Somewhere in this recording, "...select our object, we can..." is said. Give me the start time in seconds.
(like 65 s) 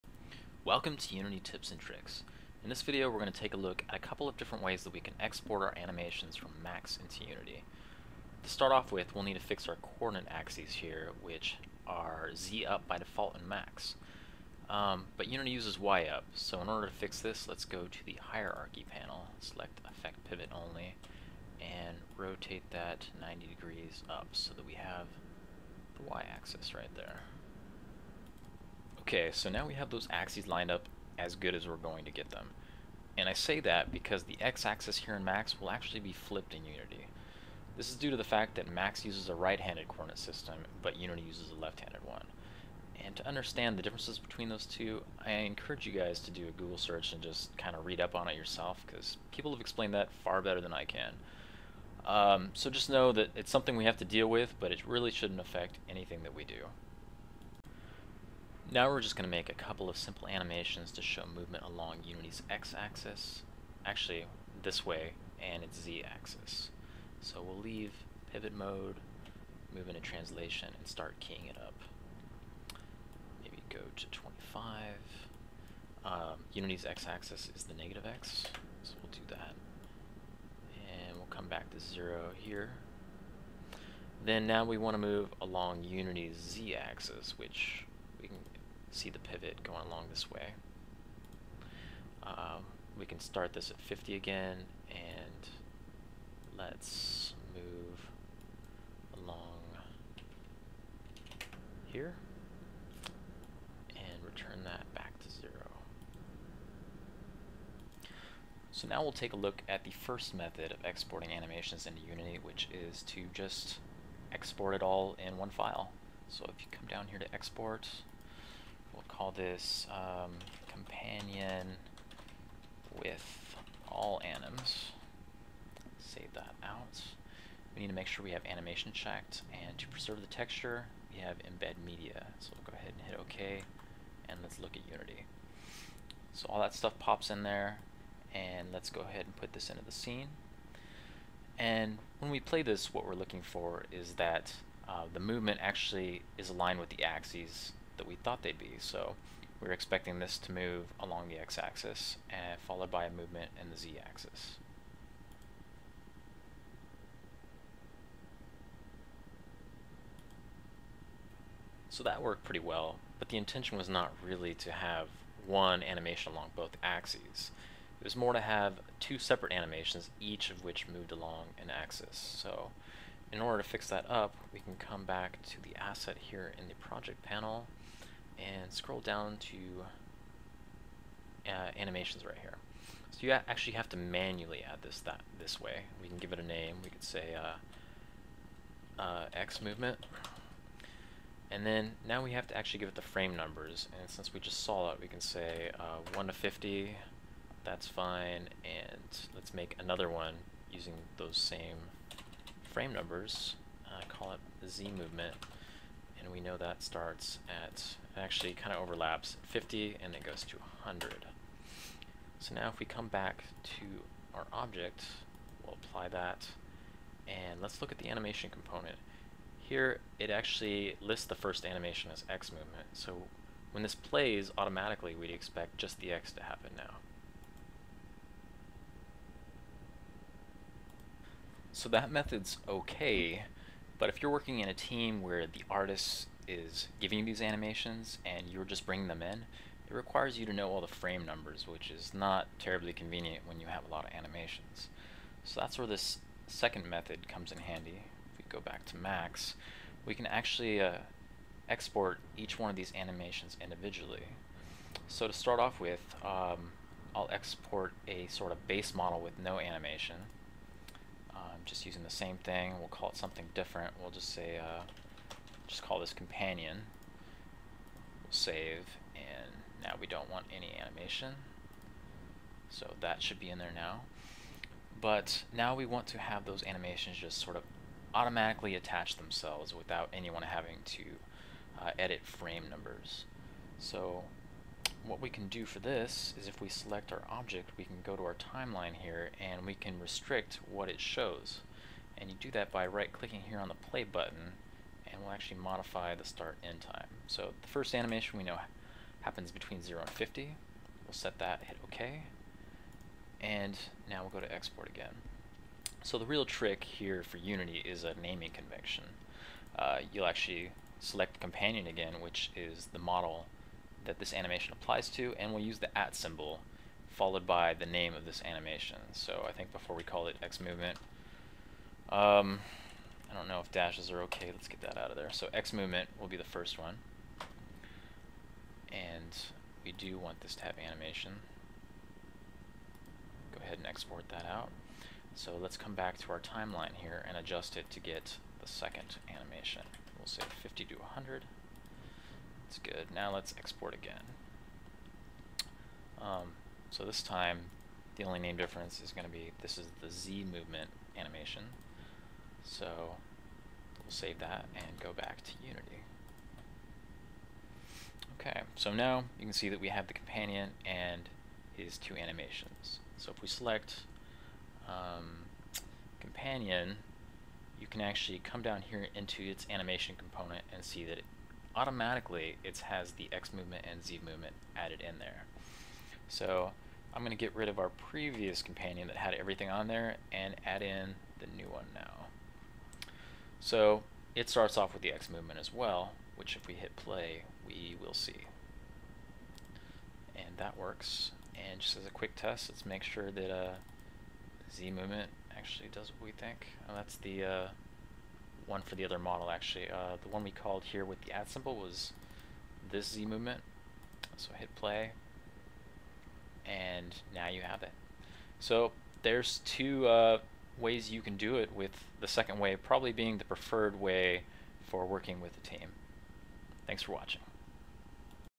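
286 s.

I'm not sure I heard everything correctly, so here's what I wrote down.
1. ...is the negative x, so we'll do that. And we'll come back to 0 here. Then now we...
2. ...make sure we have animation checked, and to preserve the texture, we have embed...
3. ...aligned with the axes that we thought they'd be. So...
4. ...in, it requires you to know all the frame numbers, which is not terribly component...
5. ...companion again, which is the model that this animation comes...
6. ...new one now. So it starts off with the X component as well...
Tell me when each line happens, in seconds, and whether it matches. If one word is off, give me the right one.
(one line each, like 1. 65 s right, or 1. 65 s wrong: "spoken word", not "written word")
1. 77 s right
2. 127 s right
3. 146 s right
4. 239 s wrong: "convenient", not "component"
5. 311 s wrong: "applies", not "comes"
6. 381 s wrong: "movement", not "component".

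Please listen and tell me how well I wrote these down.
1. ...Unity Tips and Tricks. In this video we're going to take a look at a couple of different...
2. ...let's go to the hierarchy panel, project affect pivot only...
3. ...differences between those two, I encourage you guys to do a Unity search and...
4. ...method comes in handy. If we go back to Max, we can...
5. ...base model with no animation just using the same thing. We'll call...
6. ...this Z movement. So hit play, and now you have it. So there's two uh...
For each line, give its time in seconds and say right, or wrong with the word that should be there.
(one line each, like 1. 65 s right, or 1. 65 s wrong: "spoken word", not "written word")
1. 1 s right
2. 17 s wrong: "select", not "project"
3. 43 s wrong: "Google", not "Unity"
4. 246 s right
5. 258 s right
6. 402 s right.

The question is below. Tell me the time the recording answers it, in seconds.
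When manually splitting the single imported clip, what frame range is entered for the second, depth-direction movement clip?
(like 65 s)
209 s.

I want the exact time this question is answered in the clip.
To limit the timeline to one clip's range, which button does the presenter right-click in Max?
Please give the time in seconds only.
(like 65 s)
293 s.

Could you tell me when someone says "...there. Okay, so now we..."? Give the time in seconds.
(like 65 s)
26 s.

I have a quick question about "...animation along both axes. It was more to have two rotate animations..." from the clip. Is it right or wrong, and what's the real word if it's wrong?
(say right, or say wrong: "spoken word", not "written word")
wrong: "separate", not "rotate".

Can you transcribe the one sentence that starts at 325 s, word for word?
So X movement will be the first one.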